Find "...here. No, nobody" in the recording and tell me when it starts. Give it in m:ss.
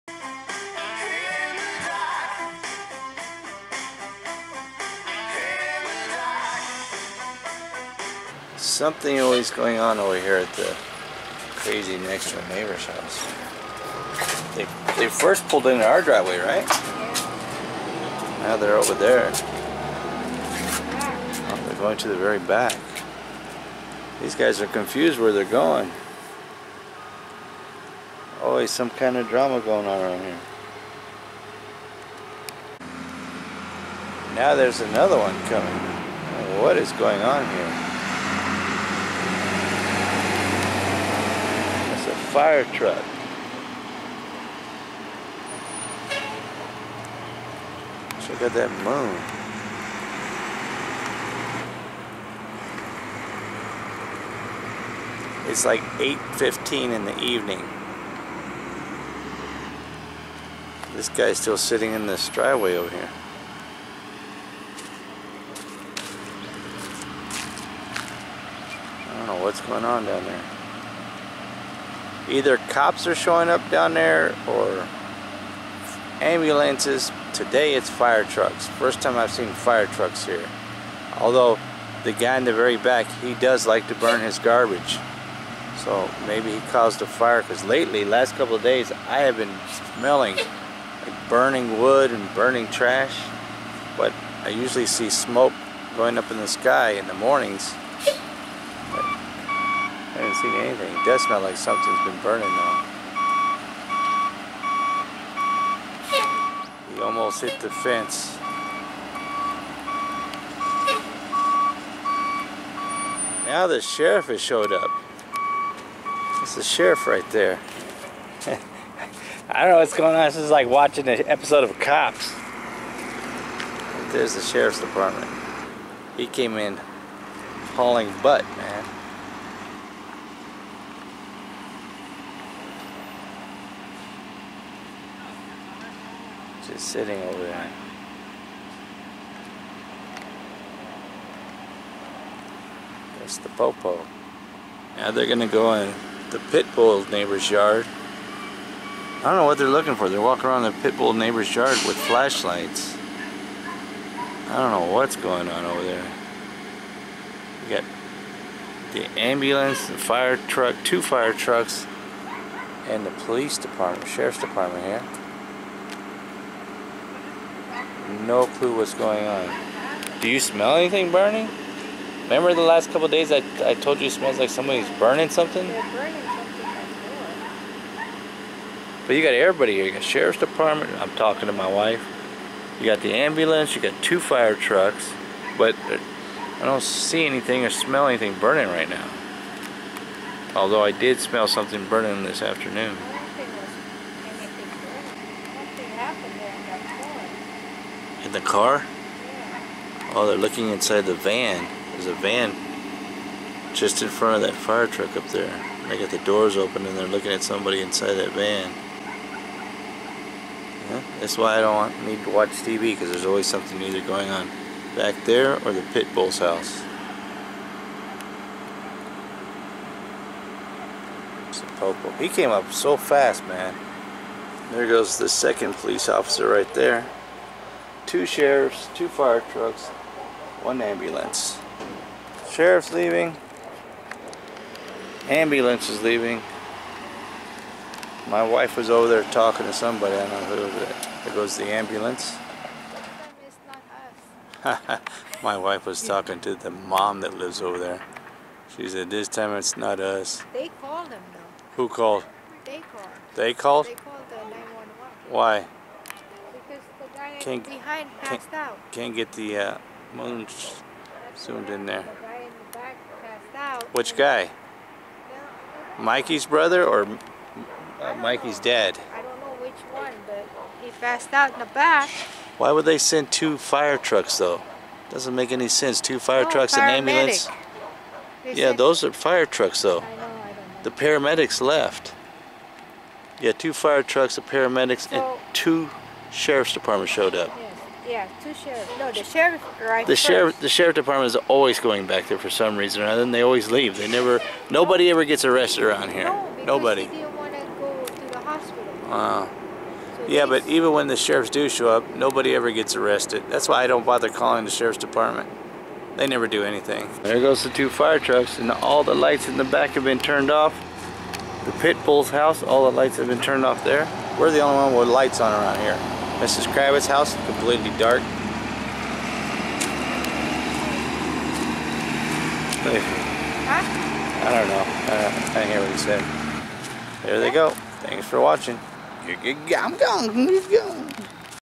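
4:56.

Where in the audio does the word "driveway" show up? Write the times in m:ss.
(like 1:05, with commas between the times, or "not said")
0:16, 1:02.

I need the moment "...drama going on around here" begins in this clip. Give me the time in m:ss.
0:29.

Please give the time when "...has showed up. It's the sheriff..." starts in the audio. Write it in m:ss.
1:54.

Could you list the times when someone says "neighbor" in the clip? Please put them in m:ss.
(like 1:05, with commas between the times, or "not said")
0:12, 2:27, 2:31.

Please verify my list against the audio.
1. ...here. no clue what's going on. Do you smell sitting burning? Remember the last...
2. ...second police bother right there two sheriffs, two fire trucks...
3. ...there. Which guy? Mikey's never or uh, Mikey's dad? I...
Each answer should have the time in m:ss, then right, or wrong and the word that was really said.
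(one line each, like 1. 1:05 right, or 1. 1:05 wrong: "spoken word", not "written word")
1. 2:44 wrong: "anything", not "sitting"
2. 3:45 wrong: "officer", not "bother"
3. 4:21 wrong: "brother", not "never".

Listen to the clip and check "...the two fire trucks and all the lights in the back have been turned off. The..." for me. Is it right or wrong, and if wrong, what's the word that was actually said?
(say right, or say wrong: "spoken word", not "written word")
right.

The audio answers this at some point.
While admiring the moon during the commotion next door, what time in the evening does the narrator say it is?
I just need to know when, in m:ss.
0:55.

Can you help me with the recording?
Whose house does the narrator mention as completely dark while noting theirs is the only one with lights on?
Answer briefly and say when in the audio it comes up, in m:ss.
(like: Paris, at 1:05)
Mrs. 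Kravitz's, at 5:16.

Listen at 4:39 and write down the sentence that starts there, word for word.
I know, I the paramedics left.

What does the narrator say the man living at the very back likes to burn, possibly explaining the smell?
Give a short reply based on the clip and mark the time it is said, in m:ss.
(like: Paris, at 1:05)
His garbage, at 1:24.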